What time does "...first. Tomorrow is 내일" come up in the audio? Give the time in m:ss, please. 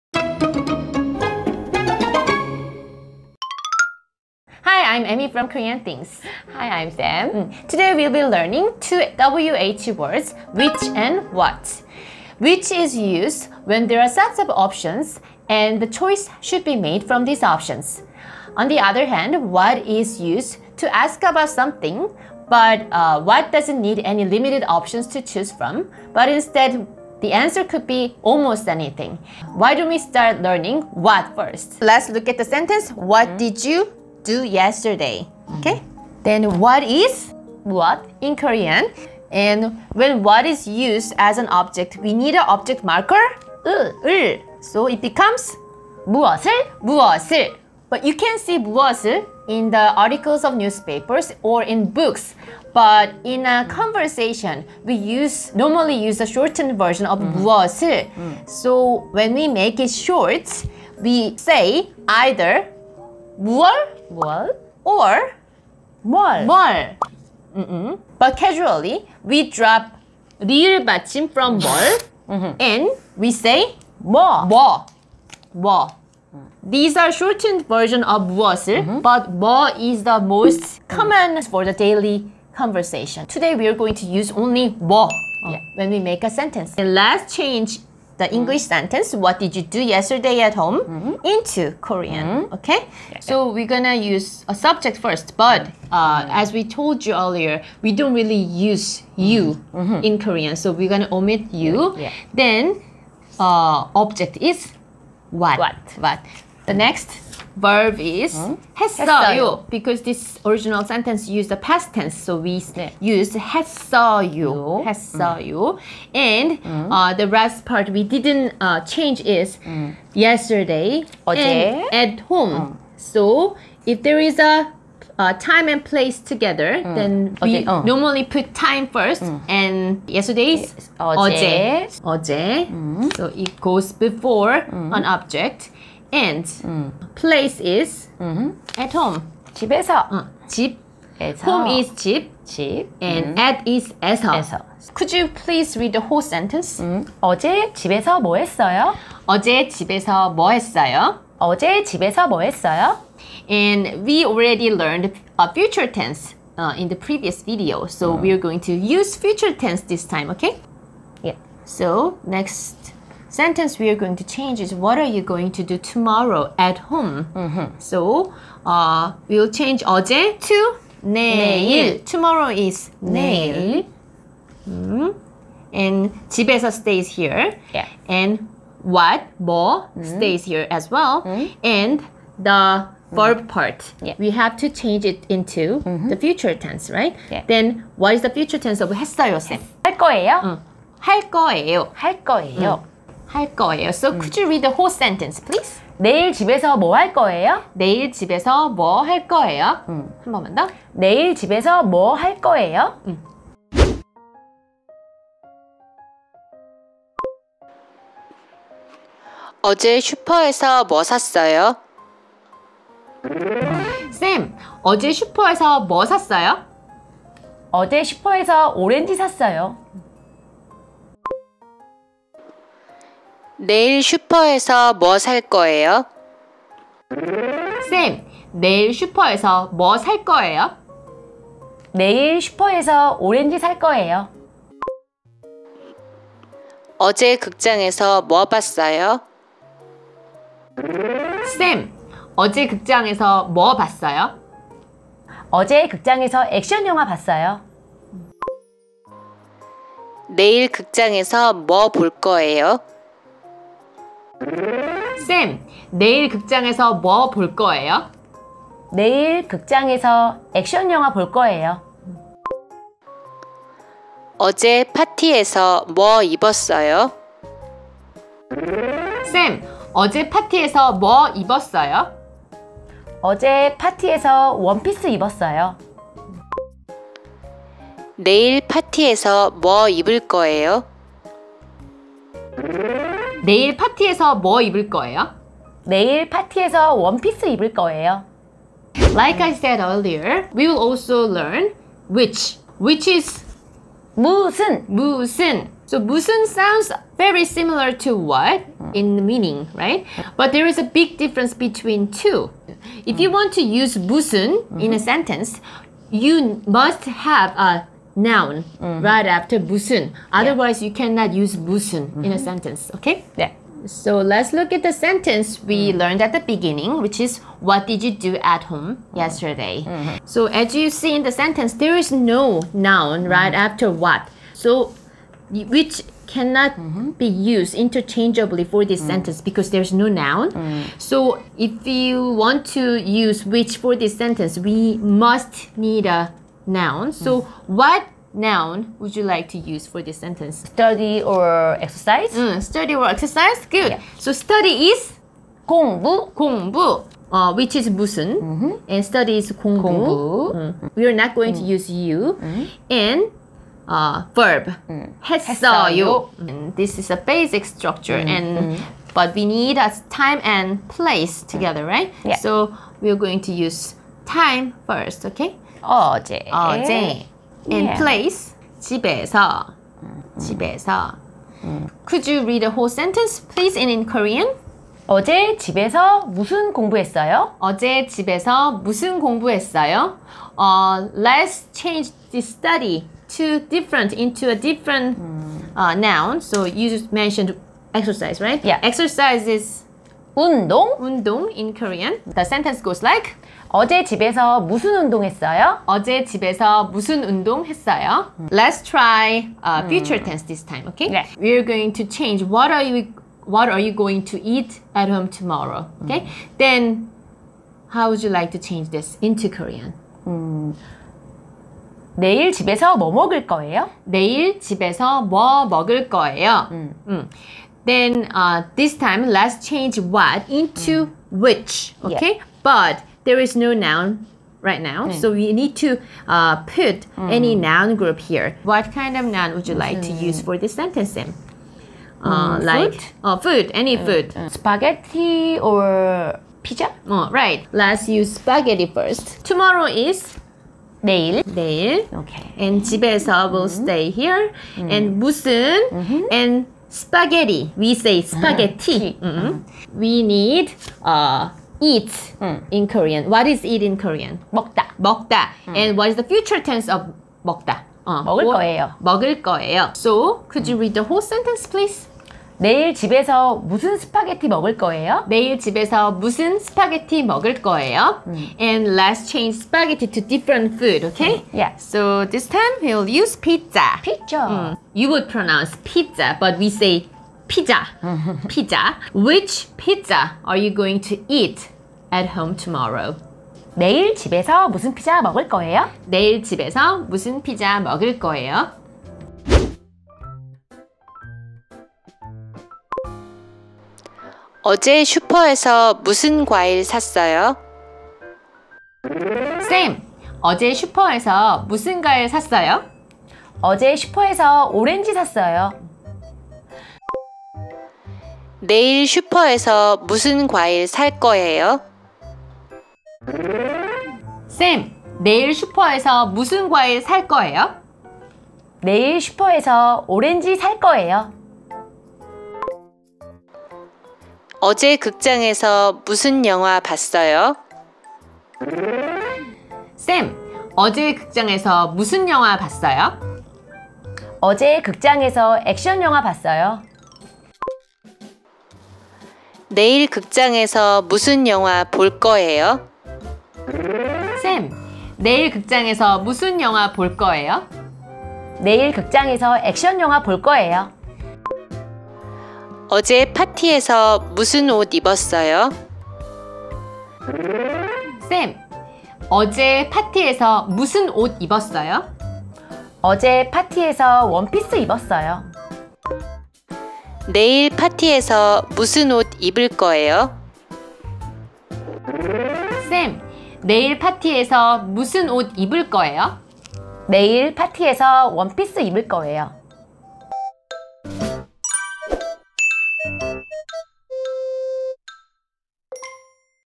7:18.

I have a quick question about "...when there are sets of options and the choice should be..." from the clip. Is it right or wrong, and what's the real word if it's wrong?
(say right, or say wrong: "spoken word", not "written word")
right.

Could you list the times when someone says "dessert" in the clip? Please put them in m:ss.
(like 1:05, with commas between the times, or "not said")
not said.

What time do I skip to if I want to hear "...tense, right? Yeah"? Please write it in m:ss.
3:06.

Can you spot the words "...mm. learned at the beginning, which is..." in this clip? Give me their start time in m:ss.
5:15.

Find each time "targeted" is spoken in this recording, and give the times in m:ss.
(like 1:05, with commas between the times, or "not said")
not said.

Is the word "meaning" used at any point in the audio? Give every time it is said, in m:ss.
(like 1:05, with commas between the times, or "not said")
4:59.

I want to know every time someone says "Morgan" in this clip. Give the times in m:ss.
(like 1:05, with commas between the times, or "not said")
not said.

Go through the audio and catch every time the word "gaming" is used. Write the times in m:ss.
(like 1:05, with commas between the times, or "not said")
not said.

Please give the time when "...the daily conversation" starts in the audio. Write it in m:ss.
1:21.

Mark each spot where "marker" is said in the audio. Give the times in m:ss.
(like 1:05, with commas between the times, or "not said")
0:42.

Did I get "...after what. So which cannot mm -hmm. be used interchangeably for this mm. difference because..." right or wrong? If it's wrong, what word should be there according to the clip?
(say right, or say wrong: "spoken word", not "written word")
wrong: "sentence", not "difference".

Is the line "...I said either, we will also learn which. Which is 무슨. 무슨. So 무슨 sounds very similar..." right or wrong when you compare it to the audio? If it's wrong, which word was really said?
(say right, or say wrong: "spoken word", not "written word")
wrong: "earlier", not "either".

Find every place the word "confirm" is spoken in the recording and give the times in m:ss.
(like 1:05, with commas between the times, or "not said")
not said.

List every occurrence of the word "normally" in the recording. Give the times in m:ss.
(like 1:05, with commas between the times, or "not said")
0:55, 2:07.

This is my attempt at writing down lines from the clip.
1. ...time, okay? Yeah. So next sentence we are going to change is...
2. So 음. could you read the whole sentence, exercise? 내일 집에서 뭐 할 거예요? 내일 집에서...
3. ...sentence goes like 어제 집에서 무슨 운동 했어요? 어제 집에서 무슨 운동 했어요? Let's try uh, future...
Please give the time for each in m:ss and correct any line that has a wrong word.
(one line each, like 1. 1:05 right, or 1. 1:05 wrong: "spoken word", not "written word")
1. 2:40 right
2. 3:13 wrong: "please", not "exercise"
3. 6:32 right.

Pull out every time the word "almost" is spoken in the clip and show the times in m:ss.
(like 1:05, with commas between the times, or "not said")
0:28.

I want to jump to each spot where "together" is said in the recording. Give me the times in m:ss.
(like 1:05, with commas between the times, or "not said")
2:06, 6:01.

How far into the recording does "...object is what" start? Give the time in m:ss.
1:43.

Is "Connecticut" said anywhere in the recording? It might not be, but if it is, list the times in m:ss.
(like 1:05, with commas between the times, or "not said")
not said.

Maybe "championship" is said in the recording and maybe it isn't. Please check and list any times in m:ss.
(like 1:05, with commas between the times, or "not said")
not said.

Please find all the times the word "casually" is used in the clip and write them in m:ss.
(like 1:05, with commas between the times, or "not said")
1:08.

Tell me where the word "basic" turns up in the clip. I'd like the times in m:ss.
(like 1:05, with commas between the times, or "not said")
5:57.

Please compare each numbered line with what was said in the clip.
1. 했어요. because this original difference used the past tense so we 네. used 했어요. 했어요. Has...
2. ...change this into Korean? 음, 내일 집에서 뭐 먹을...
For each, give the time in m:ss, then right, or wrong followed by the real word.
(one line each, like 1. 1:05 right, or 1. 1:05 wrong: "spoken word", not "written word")
1. 1:48 wrong: "sentence", not "difference"
2. 6:48 right.